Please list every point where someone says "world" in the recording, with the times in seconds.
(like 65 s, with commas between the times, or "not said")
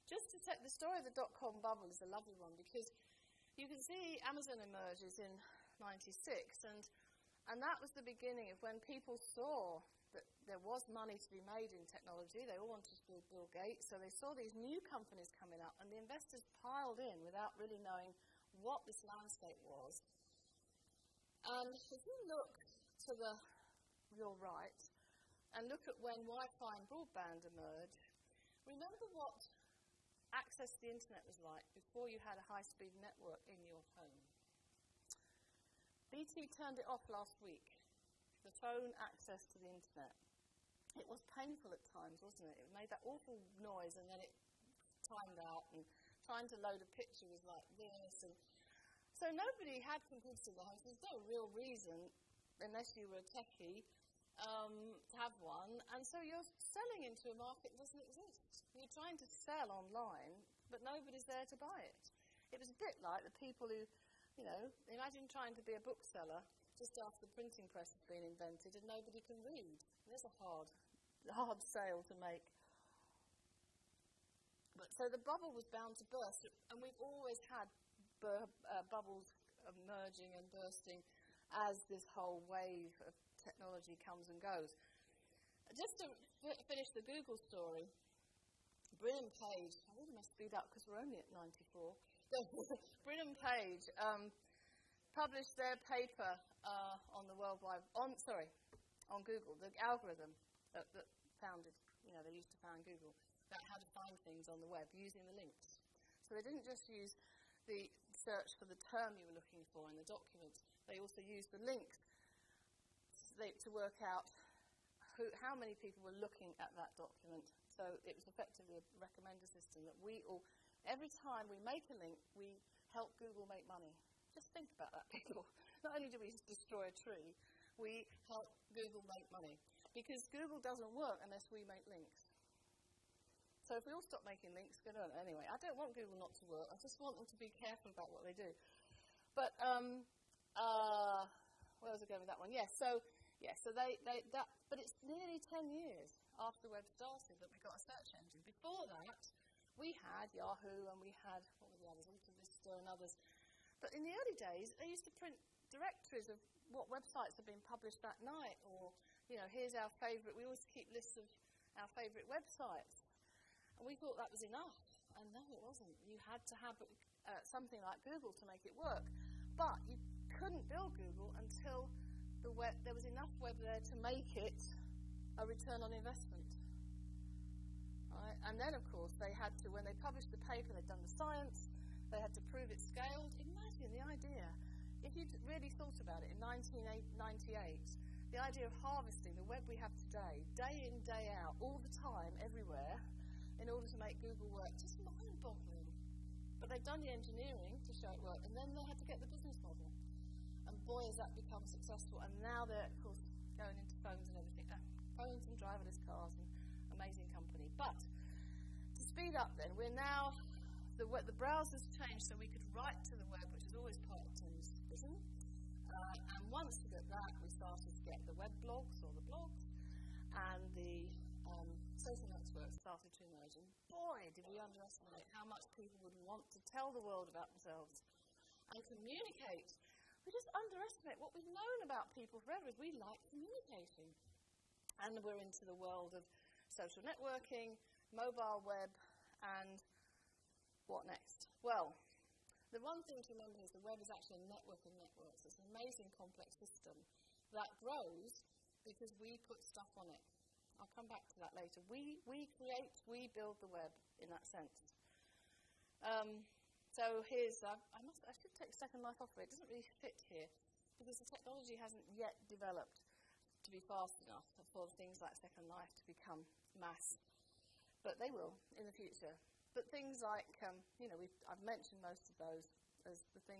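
97 s, 227 s, 235 s.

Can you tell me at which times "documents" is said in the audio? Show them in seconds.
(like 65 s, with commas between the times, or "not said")
110 s, 116 s.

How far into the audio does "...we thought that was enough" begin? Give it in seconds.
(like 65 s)
163 s.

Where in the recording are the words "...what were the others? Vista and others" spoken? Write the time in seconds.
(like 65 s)
151 s.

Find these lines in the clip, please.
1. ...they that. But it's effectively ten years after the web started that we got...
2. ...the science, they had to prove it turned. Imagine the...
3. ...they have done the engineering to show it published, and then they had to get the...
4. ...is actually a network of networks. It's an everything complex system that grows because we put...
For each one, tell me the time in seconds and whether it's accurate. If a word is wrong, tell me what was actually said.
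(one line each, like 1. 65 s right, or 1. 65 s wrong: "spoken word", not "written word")
1. 144 s wrong: "nearly", not "effectively"
2. 181 s wrong: "scaled", not "turned"
3. 196 s wrong: "worked", not "published"
4. 244 s wrong: "amazing", not "everything".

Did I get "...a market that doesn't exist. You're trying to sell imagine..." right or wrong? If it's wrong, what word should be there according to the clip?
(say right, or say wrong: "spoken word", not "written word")
wrong: "online", not "imagine".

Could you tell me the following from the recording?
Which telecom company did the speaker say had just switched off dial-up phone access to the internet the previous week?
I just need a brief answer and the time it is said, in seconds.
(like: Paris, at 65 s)
BT, at 36 s.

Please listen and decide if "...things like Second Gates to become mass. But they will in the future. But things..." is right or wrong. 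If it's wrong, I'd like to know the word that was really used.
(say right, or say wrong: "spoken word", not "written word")
wrong: "Life", not "Gates".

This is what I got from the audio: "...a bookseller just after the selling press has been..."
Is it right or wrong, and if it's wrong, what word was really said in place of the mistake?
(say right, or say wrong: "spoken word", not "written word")
wrong: "printing", not "selling".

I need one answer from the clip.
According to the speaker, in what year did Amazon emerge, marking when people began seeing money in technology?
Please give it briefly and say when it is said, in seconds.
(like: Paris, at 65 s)
1996, at 5 s.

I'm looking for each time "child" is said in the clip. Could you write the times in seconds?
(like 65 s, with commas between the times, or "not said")
not said.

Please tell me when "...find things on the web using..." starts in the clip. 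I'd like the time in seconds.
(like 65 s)
103 s.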